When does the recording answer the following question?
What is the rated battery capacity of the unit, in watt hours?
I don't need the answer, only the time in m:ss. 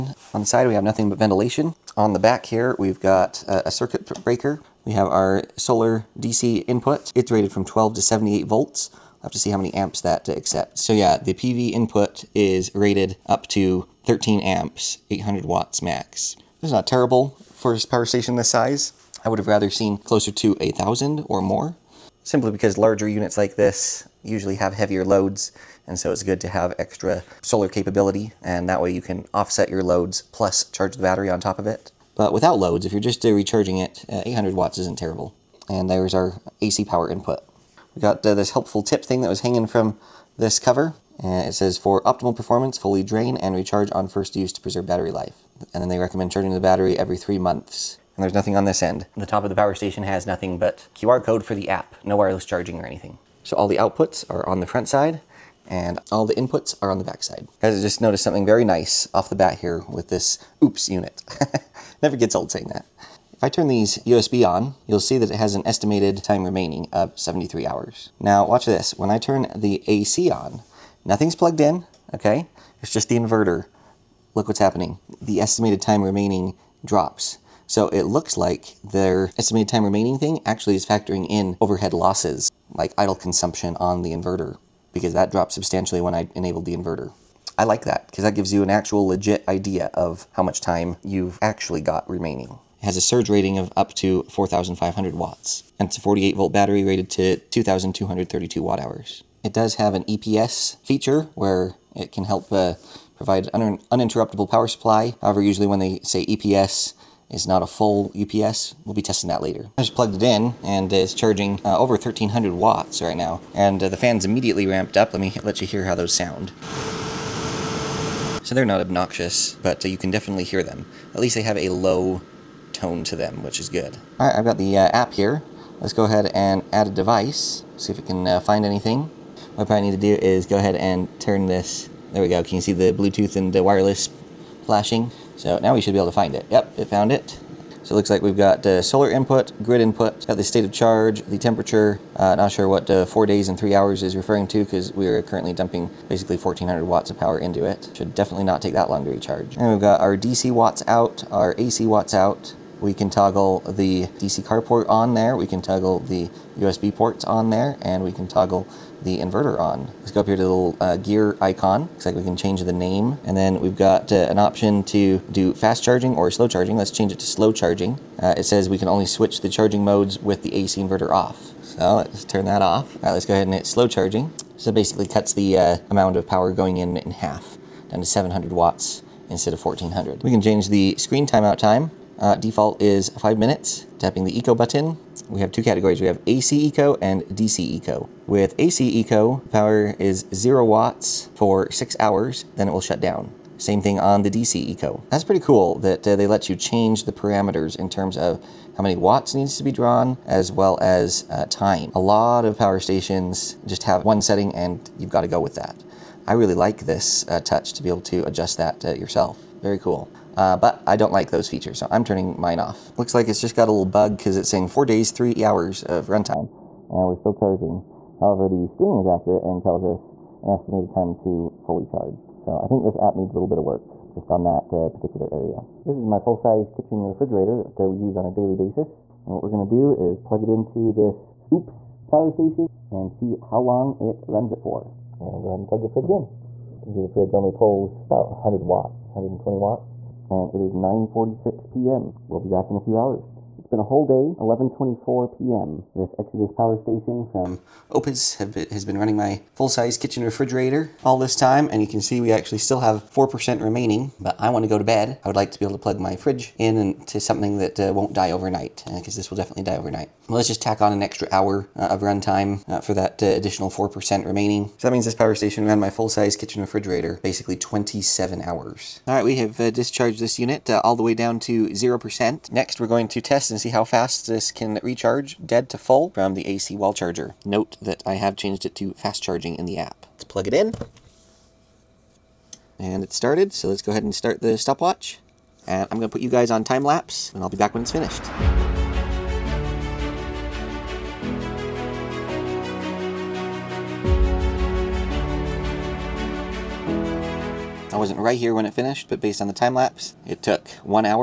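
1:37.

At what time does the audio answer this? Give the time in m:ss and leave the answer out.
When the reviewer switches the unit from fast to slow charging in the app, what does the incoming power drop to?
2:58.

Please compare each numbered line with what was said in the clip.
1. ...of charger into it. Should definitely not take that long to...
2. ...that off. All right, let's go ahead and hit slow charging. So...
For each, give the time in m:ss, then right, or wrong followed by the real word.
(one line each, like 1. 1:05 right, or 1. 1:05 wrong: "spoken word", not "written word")
1. 2:27 wrong: "power", not "charger"
2. 2:52 right.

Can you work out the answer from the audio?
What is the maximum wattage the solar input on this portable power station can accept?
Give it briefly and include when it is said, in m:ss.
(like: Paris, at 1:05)
800 watts, at 0:15.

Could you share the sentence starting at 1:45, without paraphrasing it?
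However, usually when they say EPS, is not a full UPS.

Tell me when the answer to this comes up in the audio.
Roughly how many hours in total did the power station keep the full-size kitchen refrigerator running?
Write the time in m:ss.
4:27.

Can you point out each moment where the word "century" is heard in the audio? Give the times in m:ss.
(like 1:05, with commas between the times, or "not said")
not said.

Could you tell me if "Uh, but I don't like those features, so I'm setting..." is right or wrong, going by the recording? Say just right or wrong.
wrong.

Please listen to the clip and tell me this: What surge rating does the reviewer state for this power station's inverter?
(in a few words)
4,500 watts.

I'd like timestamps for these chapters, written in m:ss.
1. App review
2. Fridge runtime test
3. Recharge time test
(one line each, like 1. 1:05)
1. 2:03
2. 3:45
3. 4:28.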